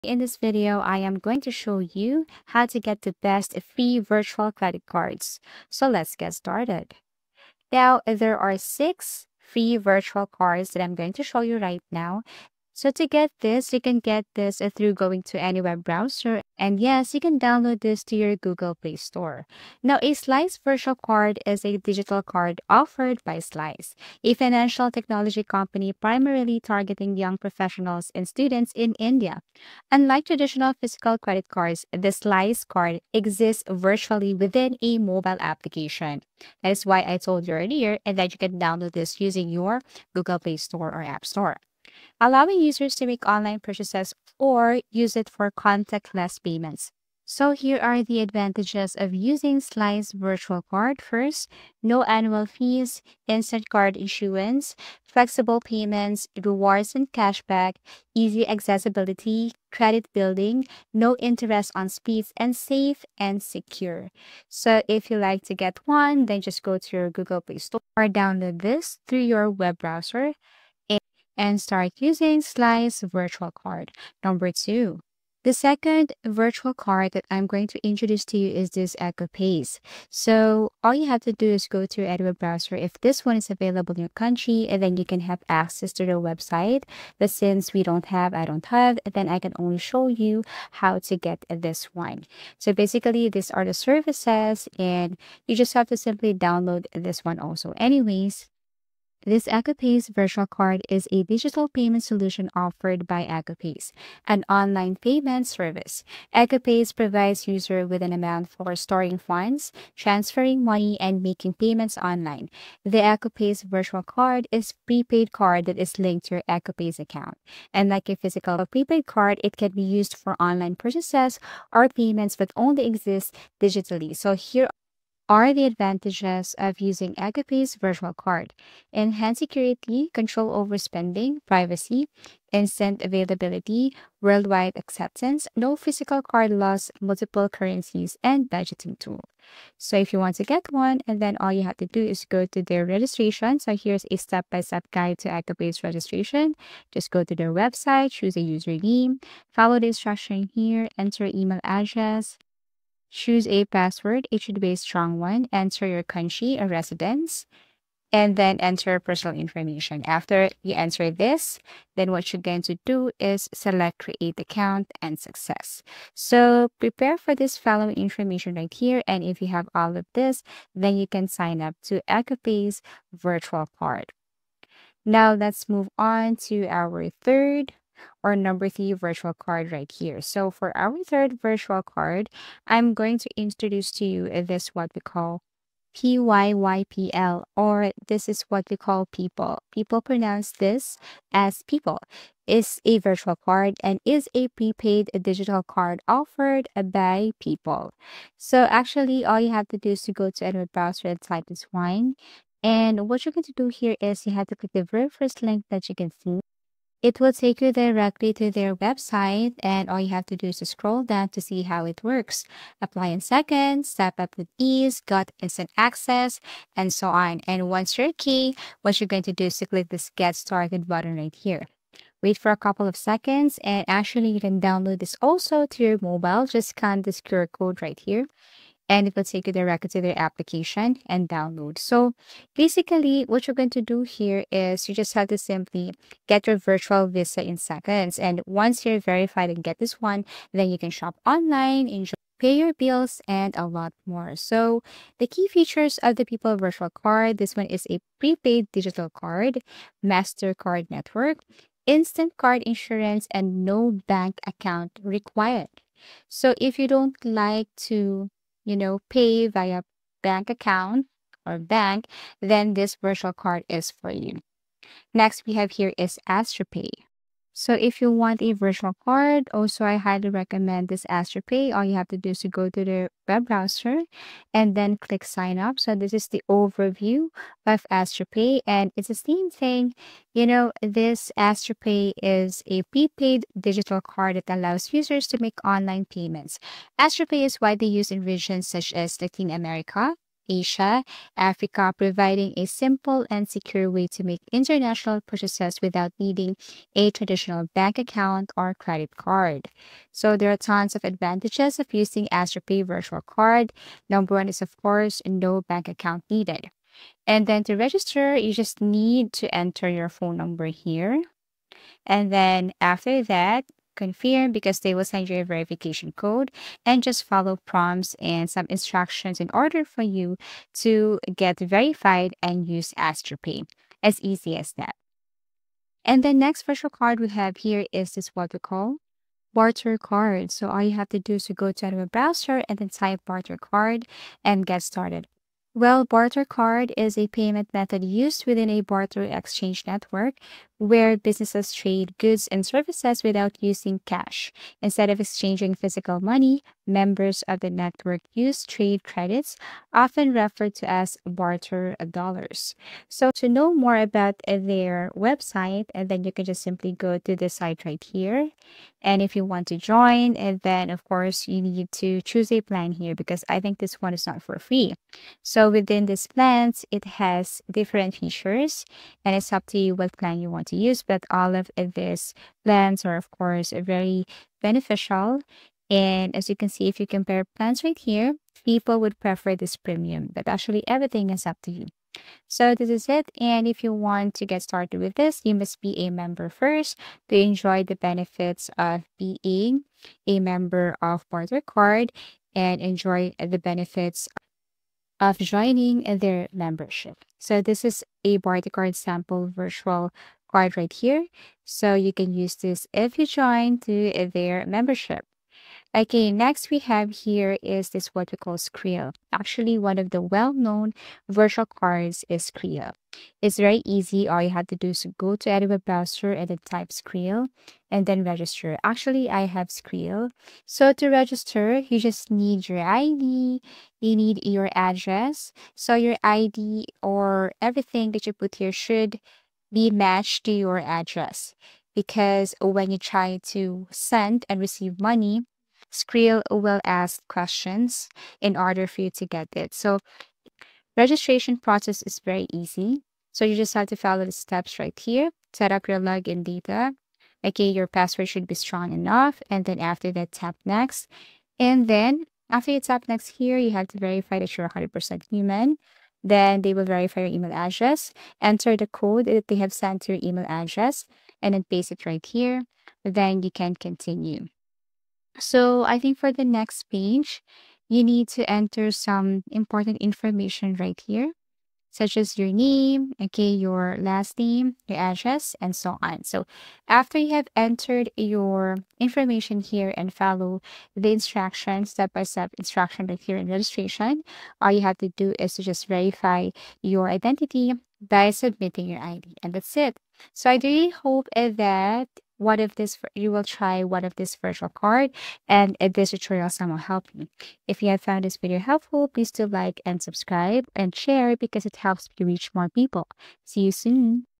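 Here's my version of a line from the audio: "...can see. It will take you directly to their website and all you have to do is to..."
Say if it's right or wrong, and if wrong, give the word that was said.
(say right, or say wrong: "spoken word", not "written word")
right.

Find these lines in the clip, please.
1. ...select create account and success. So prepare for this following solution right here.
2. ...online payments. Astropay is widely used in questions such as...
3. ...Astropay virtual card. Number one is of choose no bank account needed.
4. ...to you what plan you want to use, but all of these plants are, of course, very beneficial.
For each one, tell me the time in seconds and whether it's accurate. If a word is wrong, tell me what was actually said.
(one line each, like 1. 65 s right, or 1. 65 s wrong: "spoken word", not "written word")
1. 163 s wrong: "information", not "solution"
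2. 285 s wrong: "regions", not "questions"
3. 302 s wrong: "course", not "choose"
4. 369 s right.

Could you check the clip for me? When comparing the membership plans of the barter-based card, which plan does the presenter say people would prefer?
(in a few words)
Premium.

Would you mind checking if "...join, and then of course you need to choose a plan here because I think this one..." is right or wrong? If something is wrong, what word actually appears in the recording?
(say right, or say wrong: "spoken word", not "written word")
right.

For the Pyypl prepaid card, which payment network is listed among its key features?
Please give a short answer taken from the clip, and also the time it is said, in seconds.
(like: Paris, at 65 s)
MasterCard, at 250 s.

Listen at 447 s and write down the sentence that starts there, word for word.
Okay, your password should be strong enough.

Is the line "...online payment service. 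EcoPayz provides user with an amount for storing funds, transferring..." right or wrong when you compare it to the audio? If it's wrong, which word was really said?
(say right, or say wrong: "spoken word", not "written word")
right.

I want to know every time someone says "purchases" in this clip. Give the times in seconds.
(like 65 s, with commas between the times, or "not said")
43 s, 120 s, 295 s.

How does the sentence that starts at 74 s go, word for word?
Number two, the second virtual card that I'm going to introduce to you is this EcoPayz.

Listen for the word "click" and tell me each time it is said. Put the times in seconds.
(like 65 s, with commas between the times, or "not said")
204 s, 219 s, 274 s.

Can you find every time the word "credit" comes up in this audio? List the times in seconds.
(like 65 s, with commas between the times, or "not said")
4 s, 31 s, 59 s, 298 s, 349 s.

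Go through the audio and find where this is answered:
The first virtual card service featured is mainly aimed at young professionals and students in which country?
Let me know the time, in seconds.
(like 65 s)
28 s.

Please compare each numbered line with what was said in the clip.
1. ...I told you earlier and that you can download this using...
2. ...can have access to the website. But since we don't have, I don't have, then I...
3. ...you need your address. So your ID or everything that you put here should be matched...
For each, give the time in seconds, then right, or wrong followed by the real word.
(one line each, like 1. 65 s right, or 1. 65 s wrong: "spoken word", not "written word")
1. 37 s right
2. 85 s right
3. 423 s right.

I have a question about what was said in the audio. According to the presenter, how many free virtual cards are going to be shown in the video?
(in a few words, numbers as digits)
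6.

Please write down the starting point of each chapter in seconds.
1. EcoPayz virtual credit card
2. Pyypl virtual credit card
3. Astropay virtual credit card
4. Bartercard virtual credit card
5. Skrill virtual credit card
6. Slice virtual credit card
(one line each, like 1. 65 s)
1. 75 s
2. 182 s
3. 265 s
4. 325 s
5. 405 s
6. 20 s.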